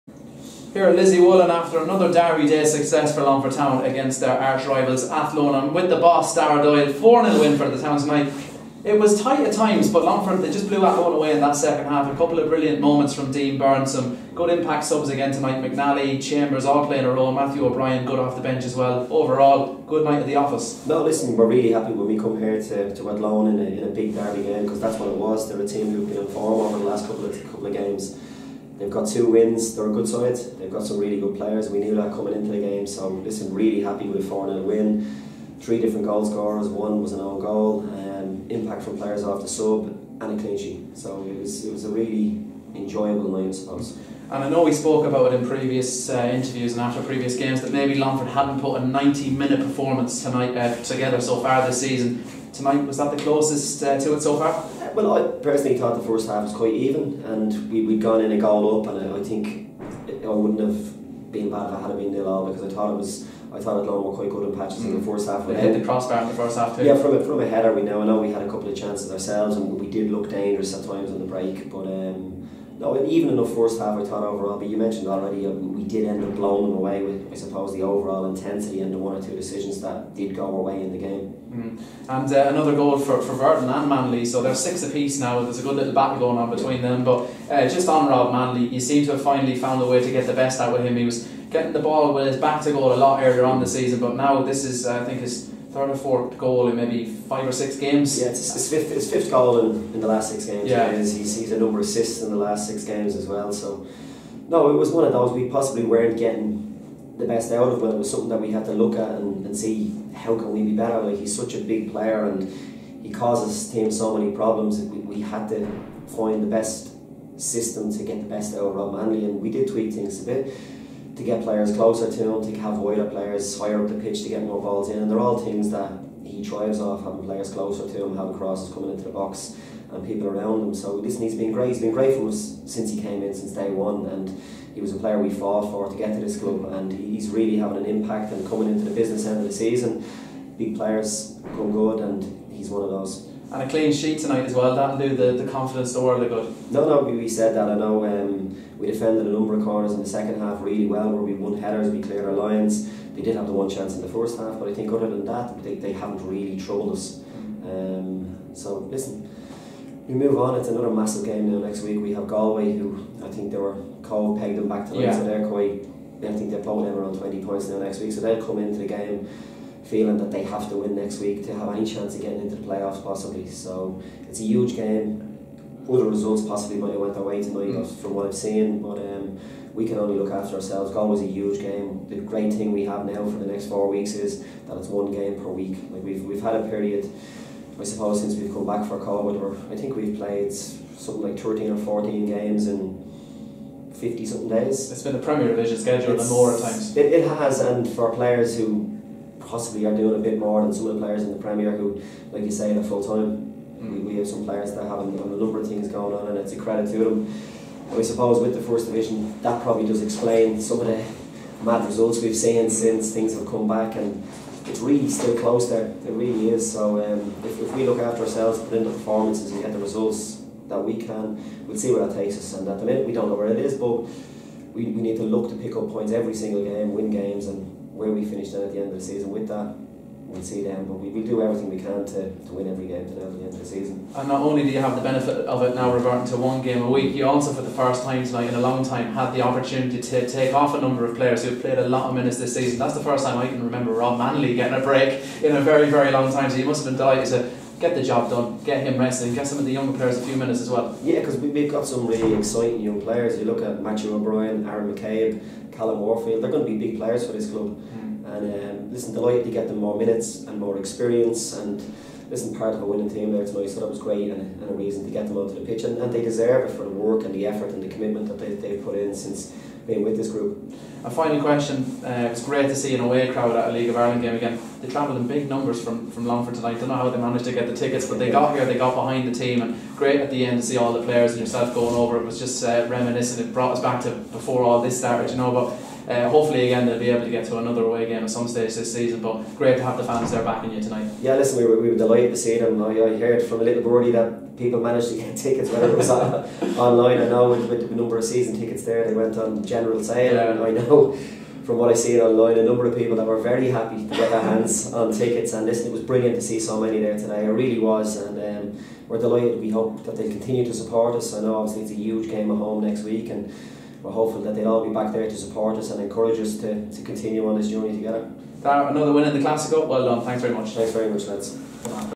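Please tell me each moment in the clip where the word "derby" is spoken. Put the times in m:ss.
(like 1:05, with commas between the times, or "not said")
0:24.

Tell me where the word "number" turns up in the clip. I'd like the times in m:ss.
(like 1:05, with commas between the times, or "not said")
1:41, 2:29, 3:25, 4:00, 4:35, 4:57, 5:02.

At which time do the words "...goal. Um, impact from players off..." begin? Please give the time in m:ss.
0:37.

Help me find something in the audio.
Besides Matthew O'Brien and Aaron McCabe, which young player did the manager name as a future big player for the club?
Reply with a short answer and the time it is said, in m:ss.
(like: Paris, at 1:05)
Callum Warfield, at 4:15.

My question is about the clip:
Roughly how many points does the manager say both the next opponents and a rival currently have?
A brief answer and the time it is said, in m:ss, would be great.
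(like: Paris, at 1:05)
20, at 2:47.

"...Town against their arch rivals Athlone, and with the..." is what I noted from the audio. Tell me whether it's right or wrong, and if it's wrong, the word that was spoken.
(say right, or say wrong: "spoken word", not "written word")
right.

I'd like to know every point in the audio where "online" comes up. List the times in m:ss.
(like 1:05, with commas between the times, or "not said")
4:56, 5:02.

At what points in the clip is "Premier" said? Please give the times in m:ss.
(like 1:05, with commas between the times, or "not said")
3:15, 3:21.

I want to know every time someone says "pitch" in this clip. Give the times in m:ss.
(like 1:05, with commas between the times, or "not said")
2:03, 4:25.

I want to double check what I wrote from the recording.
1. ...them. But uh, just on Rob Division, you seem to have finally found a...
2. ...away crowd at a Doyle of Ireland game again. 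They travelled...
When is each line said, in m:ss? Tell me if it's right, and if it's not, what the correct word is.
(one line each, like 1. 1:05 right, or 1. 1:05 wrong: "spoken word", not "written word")
1. 1:26 wrong: "Manley", not "Division"
2. 4:33 wrong: "League", not "Doyle".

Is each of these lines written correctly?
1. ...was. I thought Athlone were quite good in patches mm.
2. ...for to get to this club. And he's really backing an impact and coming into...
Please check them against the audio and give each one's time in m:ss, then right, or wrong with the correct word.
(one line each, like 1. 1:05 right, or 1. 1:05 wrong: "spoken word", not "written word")
1. 1:02 right
2. 2:15 wrong: "having", not "backing".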